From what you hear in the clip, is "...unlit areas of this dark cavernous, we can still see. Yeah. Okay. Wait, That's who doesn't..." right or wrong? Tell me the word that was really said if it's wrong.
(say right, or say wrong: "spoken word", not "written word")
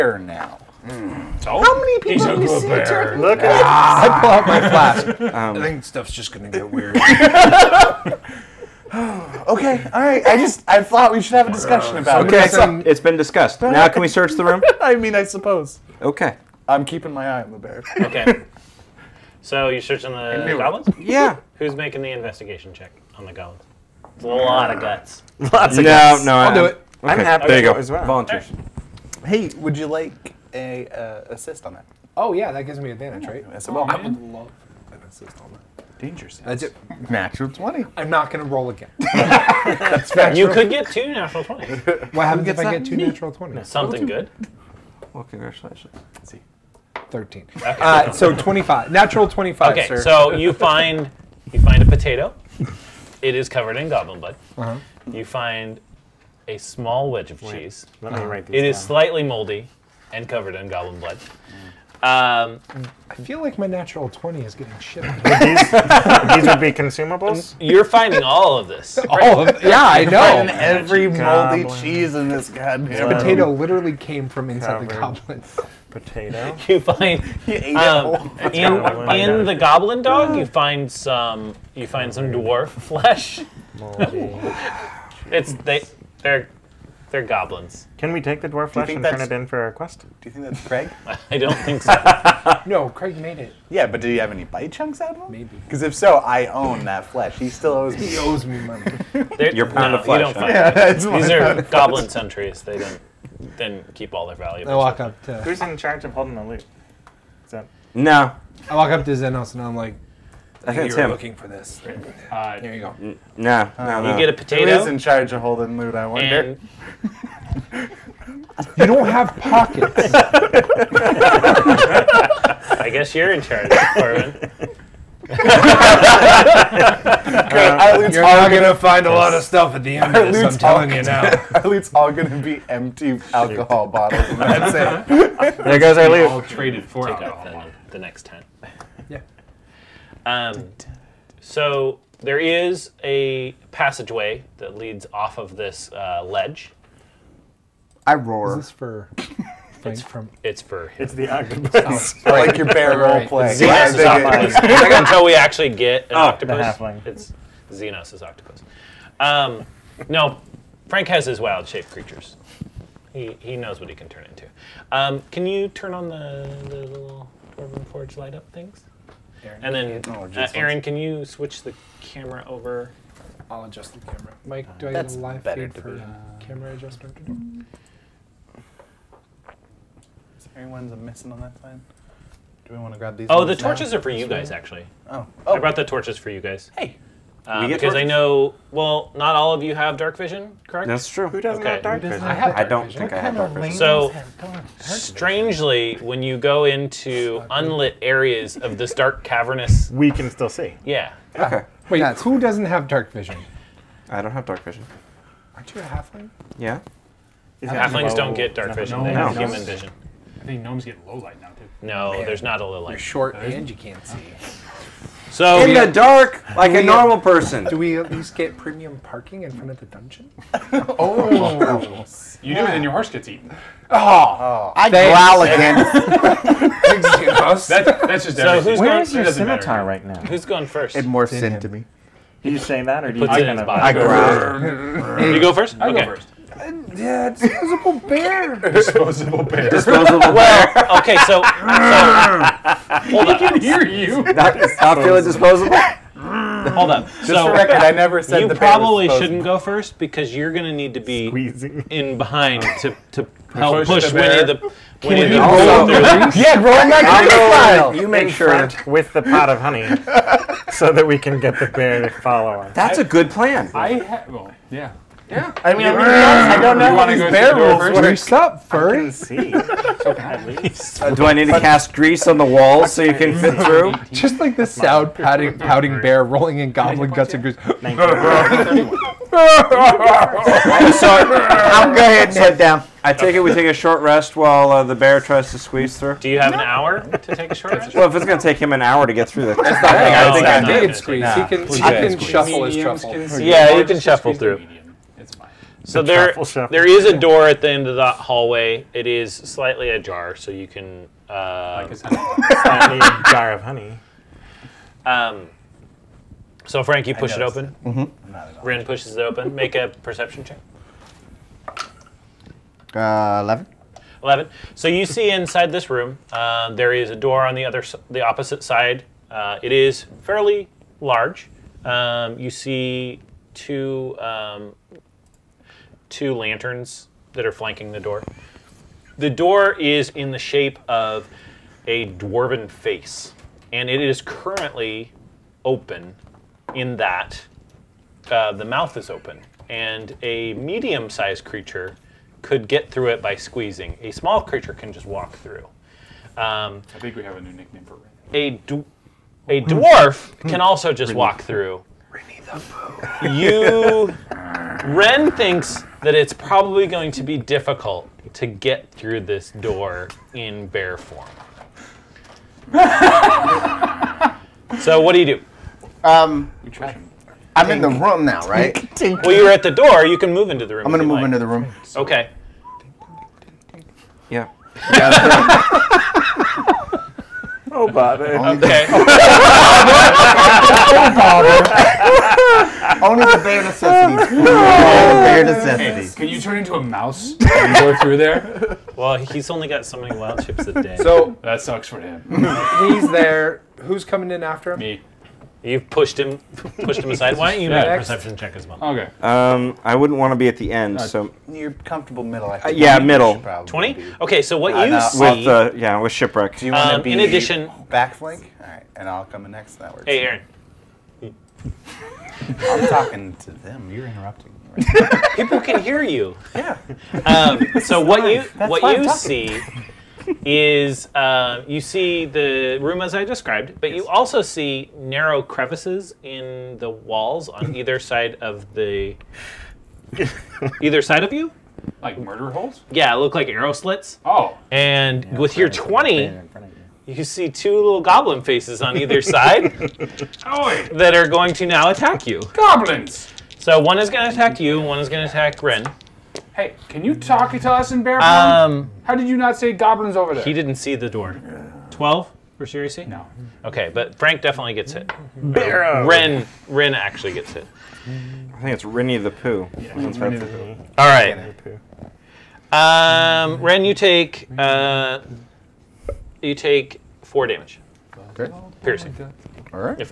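right.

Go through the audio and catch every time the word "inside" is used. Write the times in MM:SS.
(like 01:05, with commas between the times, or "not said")
01:14, 05:15.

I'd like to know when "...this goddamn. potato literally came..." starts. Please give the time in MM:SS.
01:12.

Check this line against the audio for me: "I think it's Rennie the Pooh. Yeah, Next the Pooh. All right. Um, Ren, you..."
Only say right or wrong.
wrong.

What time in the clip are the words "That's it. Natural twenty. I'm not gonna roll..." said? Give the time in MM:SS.
00:36.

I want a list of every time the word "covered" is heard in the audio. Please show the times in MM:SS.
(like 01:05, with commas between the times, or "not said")
00:53, 01:00.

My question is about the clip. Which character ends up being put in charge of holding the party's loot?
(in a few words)
Corvin.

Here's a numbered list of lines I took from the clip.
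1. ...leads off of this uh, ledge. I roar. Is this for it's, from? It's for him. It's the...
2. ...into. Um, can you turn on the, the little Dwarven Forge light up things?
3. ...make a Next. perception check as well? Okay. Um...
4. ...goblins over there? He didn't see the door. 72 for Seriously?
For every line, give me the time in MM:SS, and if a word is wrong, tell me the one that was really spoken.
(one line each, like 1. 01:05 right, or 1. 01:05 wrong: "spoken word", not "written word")
1. 02:24 right
2. 02:44 right
3. 06:37 right
4. 07:29 wrong: "12", not "72".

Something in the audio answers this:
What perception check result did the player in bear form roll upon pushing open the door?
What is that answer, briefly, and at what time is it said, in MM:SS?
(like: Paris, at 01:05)
11, at 05:13.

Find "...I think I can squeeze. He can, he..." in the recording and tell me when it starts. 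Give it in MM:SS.
04:49.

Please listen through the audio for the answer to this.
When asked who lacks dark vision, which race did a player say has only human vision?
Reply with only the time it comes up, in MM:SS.
03:25.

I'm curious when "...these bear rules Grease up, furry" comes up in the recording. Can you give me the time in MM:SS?
04:27.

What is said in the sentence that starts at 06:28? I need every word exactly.
Well, he's only got so many wild chips a day.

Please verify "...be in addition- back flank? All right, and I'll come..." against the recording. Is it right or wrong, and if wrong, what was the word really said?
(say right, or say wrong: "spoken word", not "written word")
right.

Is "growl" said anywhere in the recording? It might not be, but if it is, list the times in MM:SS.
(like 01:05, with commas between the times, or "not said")
03:44, 03:53.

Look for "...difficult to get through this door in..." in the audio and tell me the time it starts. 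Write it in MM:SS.
05:57.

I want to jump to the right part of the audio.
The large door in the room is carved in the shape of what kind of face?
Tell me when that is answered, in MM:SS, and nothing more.
05:32.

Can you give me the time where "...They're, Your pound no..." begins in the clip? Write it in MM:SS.
01:39.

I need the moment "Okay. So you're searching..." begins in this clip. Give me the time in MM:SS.
00:18.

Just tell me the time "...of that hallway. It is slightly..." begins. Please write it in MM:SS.
04:57.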